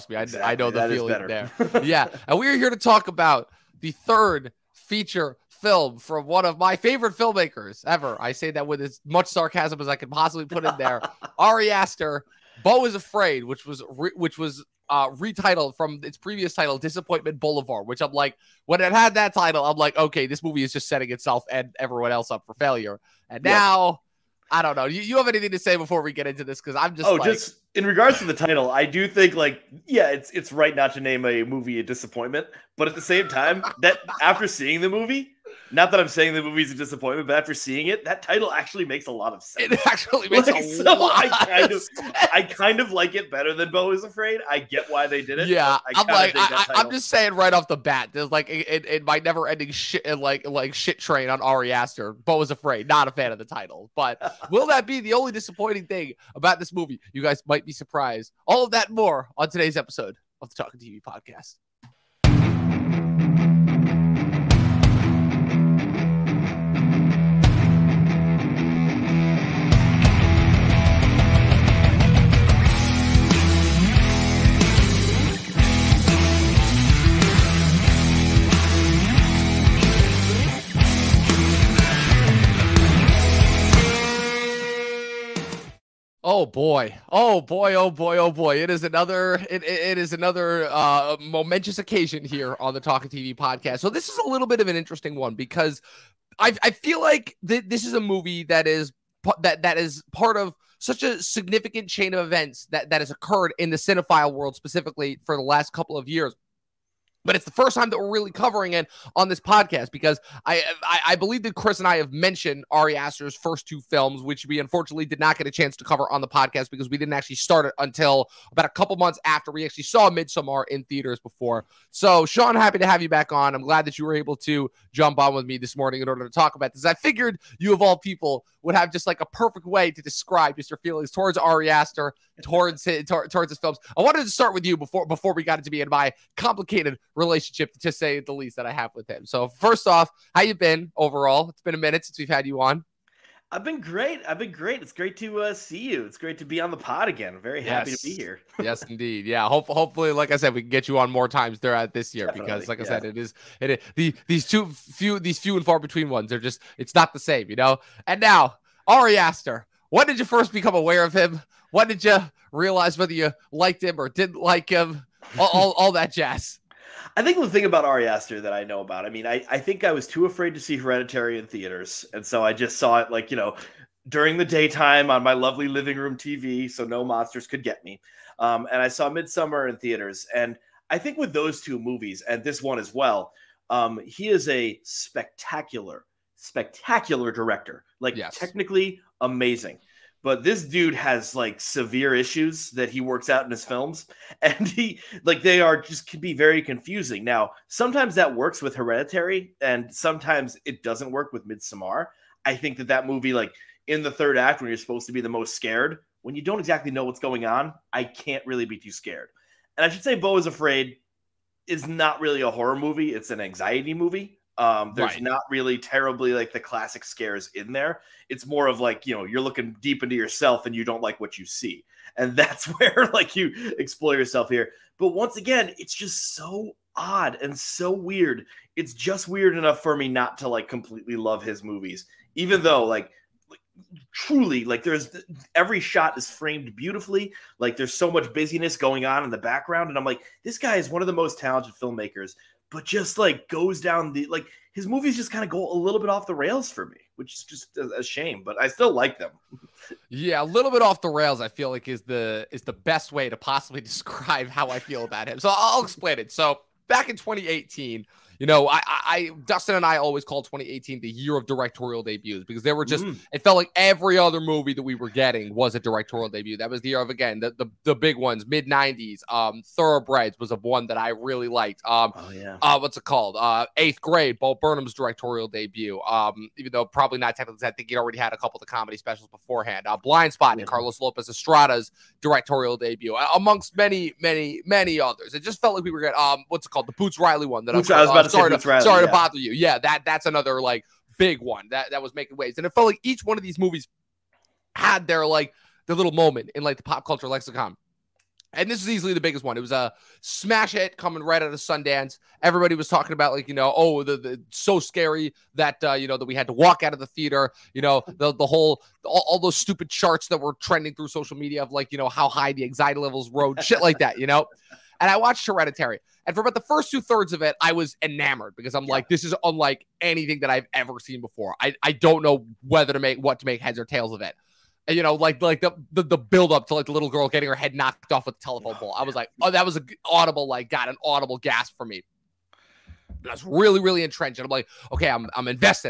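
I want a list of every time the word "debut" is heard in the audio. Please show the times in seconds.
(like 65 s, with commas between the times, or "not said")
262 s, 266 s, 275 s, 282 s.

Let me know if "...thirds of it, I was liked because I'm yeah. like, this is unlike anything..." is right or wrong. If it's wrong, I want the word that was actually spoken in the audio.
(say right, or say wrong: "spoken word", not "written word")
wrong: "enamored", not "liked".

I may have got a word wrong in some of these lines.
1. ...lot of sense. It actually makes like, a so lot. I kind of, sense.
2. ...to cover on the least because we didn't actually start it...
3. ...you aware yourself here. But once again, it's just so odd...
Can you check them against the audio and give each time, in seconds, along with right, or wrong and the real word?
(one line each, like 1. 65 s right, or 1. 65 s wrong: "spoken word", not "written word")
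1. 39 s right
2. 115 s wrong: "podcast", not "least"
3. 223 s wrong: "explore", not "aware".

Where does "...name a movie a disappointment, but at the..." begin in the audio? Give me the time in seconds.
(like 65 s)
30 s.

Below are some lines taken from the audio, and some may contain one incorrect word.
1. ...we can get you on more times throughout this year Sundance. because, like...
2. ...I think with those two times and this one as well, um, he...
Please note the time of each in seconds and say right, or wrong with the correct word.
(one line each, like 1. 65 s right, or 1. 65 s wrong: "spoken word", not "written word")
1. 150 s wrong: "Definitely", not "Sundance"
2. 180 s wrong: "movies", not "times".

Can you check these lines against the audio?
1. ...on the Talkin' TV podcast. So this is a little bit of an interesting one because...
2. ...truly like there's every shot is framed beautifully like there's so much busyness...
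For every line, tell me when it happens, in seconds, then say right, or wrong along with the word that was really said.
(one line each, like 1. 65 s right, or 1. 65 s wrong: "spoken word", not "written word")
1. 92 s right
2. 234 s right.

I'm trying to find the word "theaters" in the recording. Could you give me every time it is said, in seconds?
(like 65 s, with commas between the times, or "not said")
120 s, 171 s, 179 s, 307 s.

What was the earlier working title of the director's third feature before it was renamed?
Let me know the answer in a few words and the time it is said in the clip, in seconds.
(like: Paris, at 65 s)
Disappointment Boulevard, at 16 s.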